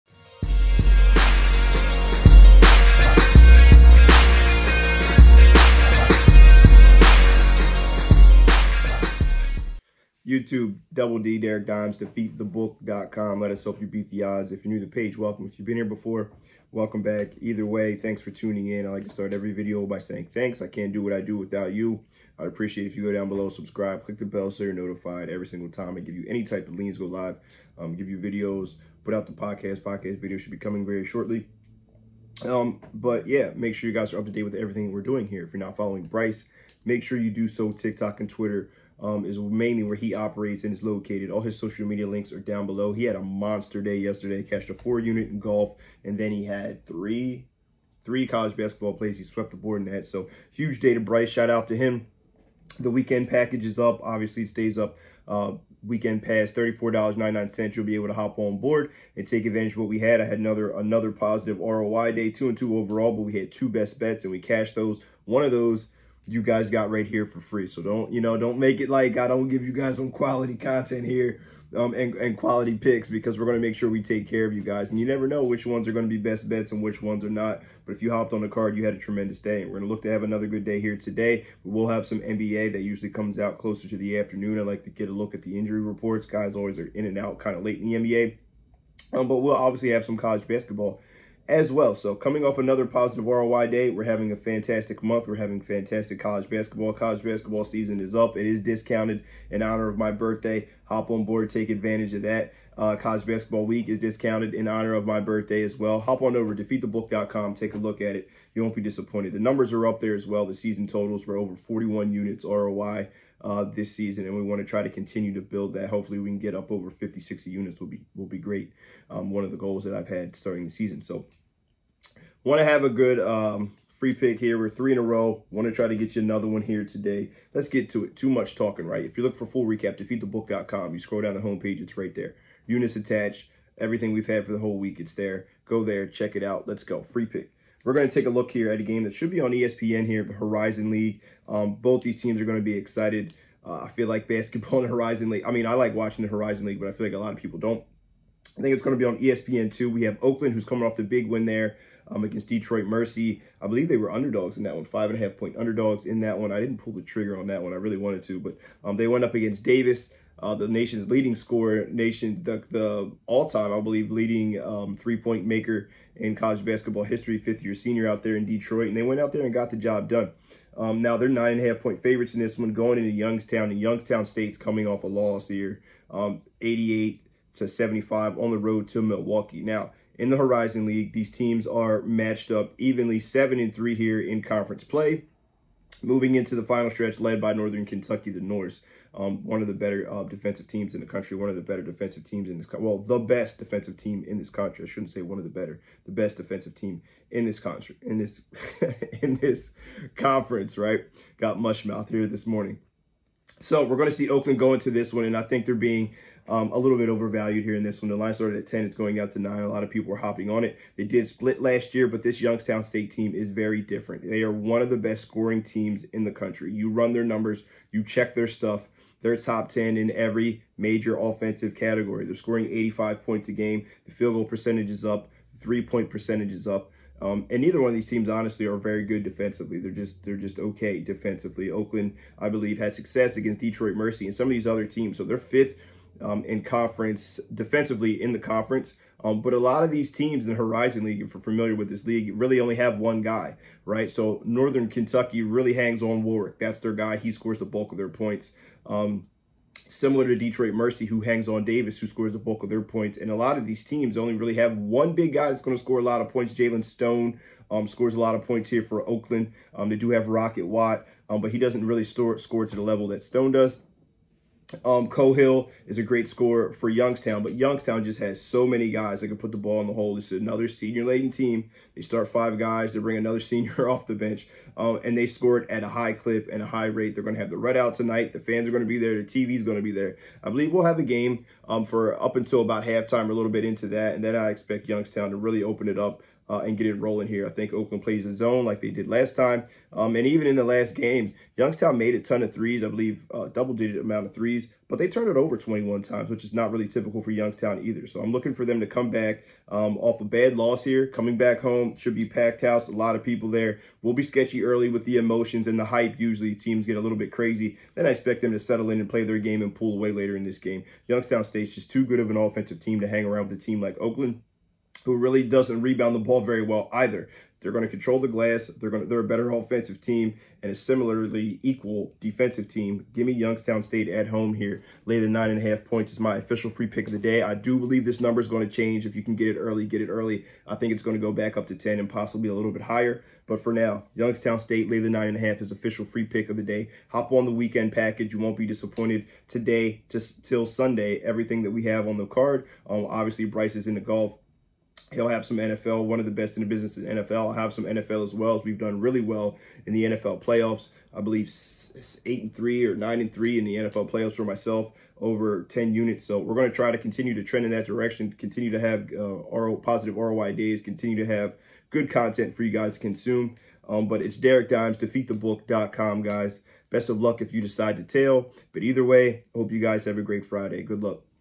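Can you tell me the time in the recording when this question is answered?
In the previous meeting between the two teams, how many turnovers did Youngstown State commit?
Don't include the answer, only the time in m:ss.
4:55.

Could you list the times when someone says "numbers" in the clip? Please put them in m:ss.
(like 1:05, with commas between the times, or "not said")
1:49, 3:37, 5:28.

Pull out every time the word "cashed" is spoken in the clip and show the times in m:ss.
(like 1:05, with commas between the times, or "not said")
0:44, 1:04.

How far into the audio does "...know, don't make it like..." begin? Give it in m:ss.
1:08.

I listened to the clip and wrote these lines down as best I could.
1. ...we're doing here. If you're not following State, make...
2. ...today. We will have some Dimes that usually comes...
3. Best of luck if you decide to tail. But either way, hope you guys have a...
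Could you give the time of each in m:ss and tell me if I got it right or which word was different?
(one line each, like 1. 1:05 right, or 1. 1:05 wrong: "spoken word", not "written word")
1. 0:34 wrong: "Bryce", not "State"
2. 1:20 wrong: "NBA", not "Dimes"
3. 6:06 right.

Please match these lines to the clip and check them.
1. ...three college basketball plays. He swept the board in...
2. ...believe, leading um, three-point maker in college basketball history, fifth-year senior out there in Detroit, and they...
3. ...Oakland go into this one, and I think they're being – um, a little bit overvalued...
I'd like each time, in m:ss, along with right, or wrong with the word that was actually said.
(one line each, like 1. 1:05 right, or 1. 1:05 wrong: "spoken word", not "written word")
1. 0:48 right
2. 2:43 right
3. 3:24 right.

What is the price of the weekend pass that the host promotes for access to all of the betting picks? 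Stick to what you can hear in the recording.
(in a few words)
$34.99.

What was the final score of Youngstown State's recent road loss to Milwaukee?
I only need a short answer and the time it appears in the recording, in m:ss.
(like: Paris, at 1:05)
88 to 75, at 2:56.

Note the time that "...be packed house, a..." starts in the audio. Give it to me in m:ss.
5:02.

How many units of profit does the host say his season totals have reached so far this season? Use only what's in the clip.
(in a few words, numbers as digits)
41.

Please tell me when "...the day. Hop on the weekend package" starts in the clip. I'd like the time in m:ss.
5:36.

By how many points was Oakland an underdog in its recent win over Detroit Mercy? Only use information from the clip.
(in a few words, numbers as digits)
5.5.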